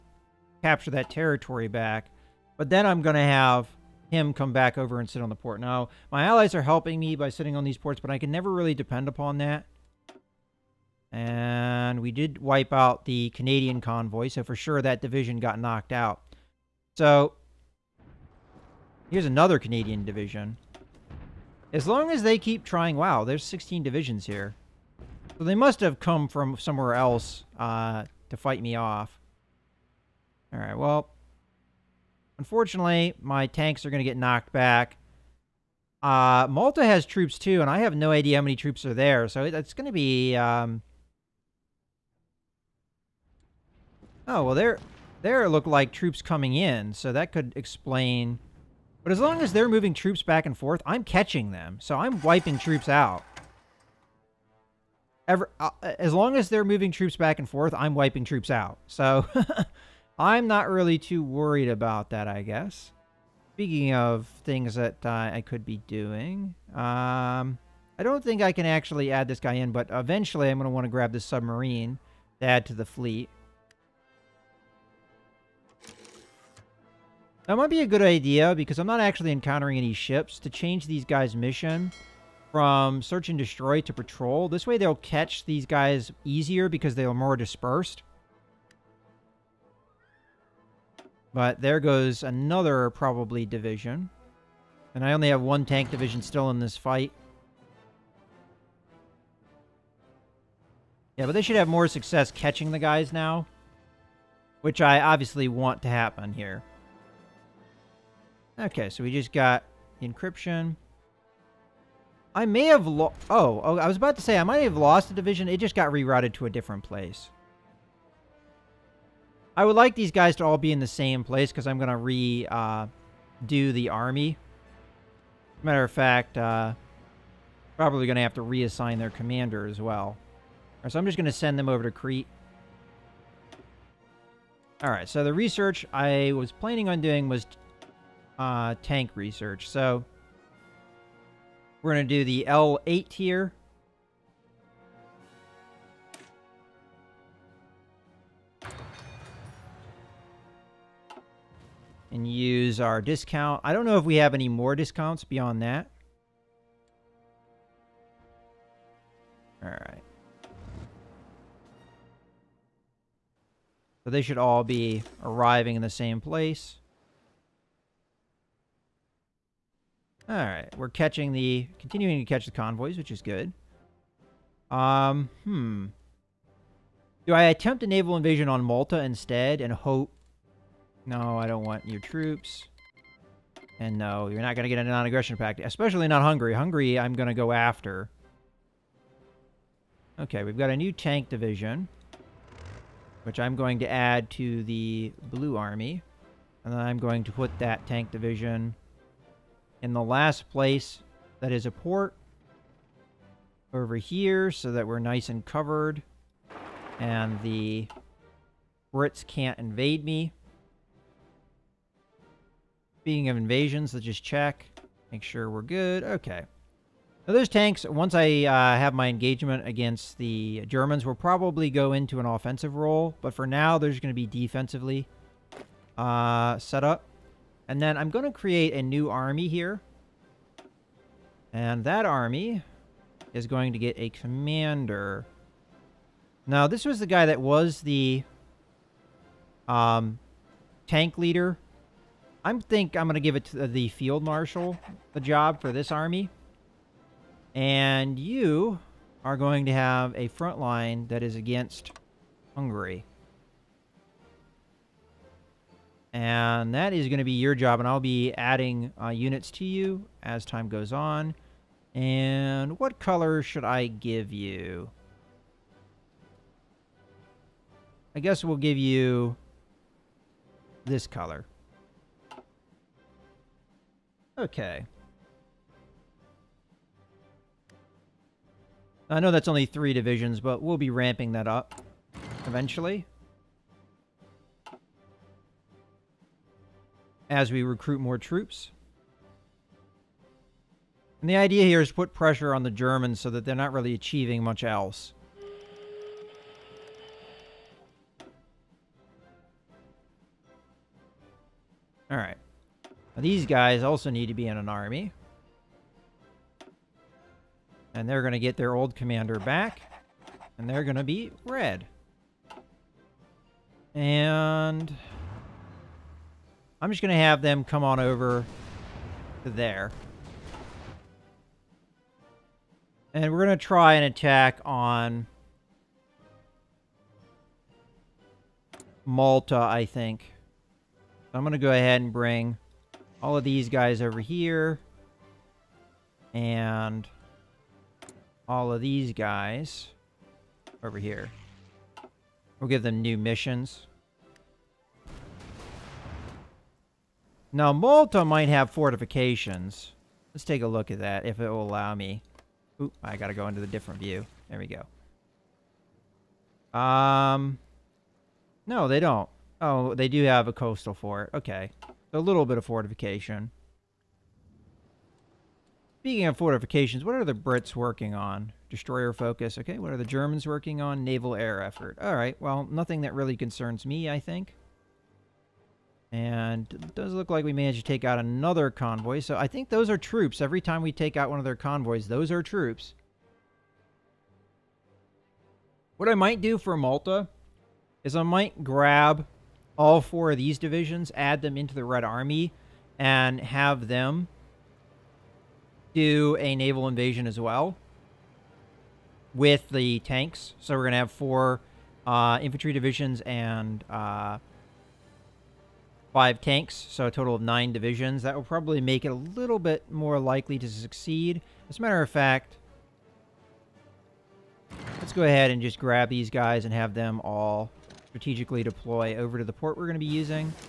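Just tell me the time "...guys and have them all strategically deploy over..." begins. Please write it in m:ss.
6:56.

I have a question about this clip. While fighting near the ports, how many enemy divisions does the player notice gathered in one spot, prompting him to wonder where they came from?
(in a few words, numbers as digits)
16.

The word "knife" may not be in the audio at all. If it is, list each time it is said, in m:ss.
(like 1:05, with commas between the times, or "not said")
not said.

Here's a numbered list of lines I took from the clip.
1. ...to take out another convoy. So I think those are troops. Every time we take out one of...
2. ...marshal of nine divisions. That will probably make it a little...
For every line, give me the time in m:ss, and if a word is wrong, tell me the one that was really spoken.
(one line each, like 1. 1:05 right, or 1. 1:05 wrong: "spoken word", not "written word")
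1. 6:17 right
2. 6:47 wrong: "total", not "marshal".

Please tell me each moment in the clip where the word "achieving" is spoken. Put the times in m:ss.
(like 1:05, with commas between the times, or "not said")
4:53.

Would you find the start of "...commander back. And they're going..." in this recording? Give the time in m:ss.
5:08.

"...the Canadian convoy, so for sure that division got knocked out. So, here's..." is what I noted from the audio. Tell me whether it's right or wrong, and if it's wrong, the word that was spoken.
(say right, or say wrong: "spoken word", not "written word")
right.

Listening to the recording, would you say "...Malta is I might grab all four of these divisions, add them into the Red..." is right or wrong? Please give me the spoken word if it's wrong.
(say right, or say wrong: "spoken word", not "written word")
right.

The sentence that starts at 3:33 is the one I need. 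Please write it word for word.
Speaking of invasions, let's just check.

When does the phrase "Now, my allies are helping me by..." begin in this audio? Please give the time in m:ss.
0:05.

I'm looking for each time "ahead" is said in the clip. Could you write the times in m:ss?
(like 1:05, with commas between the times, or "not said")
5:31, 6:55.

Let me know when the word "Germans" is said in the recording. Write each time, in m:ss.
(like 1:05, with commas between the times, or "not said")
3:40, 4:52, 6:10.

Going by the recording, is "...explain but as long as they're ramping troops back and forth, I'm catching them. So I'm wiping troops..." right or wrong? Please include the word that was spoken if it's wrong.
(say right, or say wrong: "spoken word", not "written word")
wrong: "moving", not "ramping".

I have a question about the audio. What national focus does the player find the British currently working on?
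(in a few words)
Destroyer focus.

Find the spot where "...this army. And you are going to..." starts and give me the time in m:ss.
4:05.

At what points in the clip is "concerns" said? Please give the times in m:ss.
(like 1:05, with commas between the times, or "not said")
6:13.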